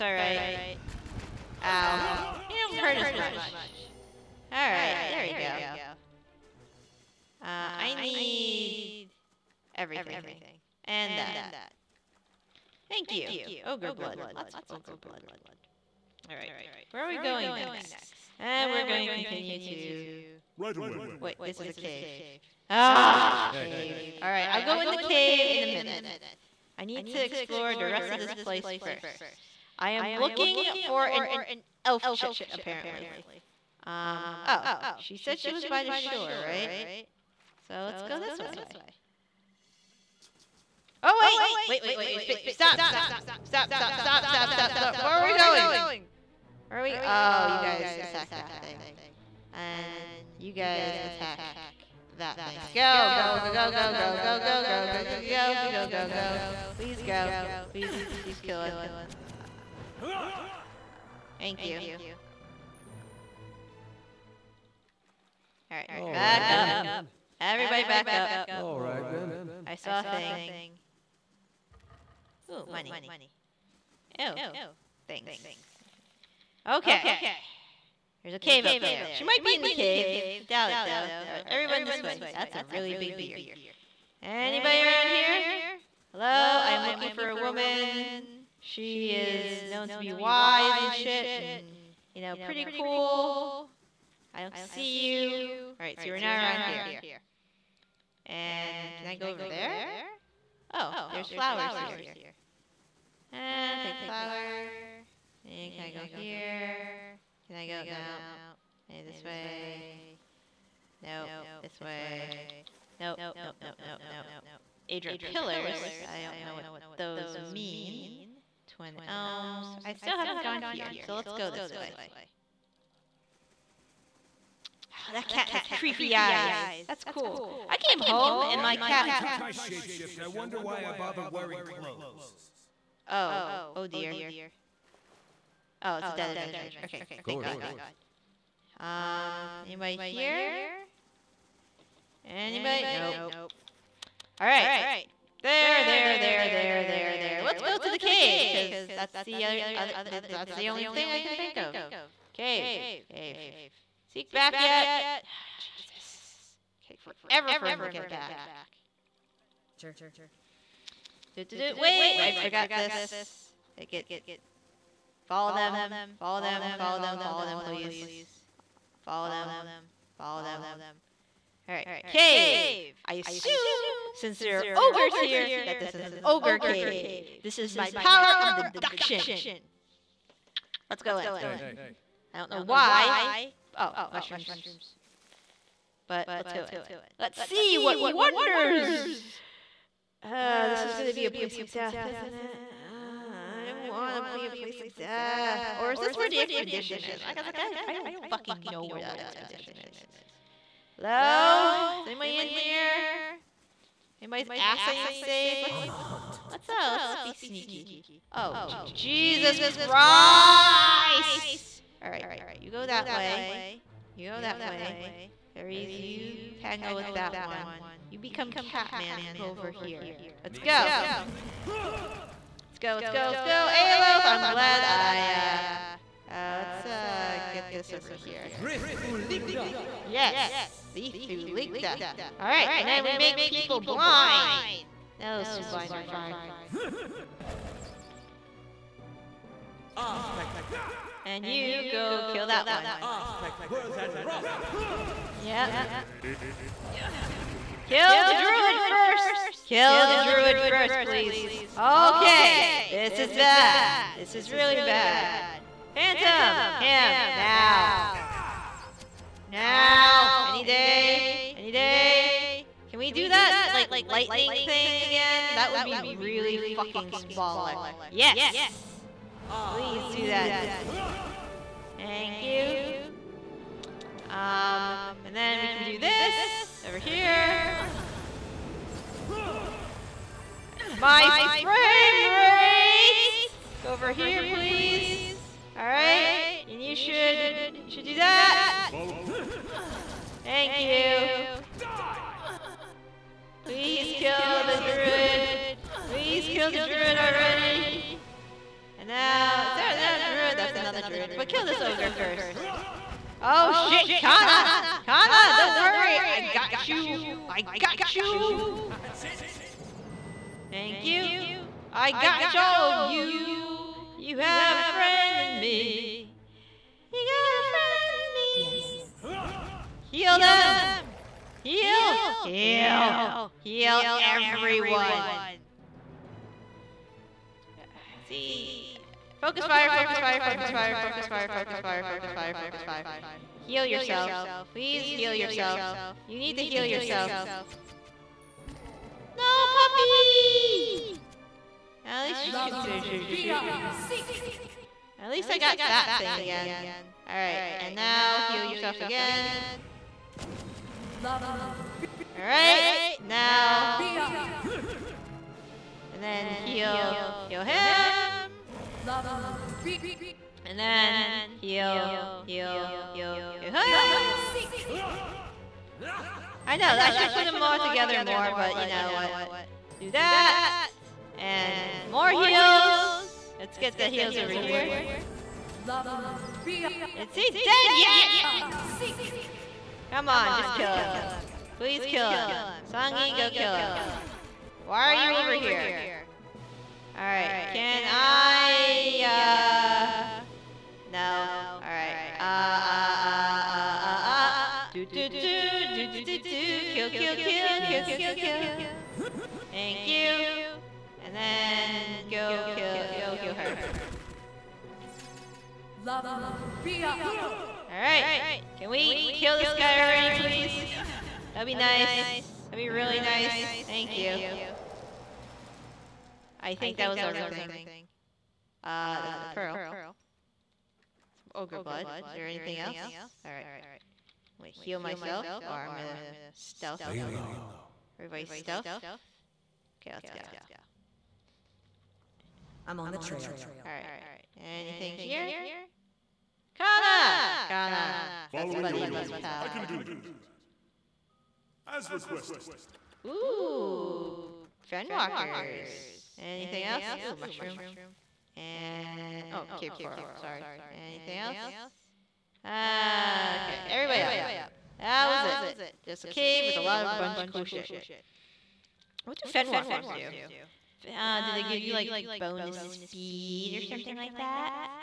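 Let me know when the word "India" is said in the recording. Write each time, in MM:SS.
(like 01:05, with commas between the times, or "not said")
not said.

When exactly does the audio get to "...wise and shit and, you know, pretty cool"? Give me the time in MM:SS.
01:30.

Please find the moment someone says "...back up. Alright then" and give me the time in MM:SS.
01:07.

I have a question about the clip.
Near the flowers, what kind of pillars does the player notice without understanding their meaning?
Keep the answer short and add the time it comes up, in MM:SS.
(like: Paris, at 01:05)
Adra pillars, at 01:54.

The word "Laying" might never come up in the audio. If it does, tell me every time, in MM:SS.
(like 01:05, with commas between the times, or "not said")
07:07.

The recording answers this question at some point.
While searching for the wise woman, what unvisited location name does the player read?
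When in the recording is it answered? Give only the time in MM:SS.
01:58.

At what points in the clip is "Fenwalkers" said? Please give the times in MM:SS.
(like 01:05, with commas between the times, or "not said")
07:24, 07:39.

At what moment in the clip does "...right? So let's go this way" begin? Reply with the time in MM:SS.
00:36.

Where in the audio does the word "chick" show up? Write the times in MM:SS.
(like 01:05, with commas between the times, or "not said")
00:32.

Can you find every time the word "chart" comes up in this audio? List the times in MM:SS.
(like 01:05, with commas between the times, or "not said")
not said.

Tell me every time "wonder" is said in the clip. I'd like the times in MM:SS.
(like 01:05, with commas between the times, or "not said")
02:10, 03:07.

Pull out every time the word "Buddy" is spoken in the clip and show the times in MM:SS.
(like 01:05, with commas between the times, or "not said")
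07:18.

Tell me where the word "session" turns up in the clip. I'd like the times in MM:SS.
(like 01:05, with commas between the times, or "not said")
not said.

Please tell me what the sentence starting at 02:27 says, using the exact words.
Let's go to the cave, because that's the other, other, that's the only thing I can think of.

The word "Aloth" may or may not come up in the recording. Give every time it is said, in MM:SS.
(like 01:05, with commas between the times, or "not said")
03:43.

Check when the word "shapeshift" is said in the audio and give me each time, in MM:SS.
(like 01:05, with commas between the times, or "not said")
02:09.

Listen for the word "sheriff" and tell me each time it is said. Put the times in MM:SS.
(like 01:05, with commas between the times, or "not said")
not said.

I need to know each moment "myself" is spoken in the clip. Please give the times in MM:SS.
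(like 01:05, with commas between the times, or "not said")
07:04.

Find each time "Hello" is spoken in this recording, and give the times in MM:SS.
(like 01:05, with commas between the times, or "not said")
01:26, 03:20.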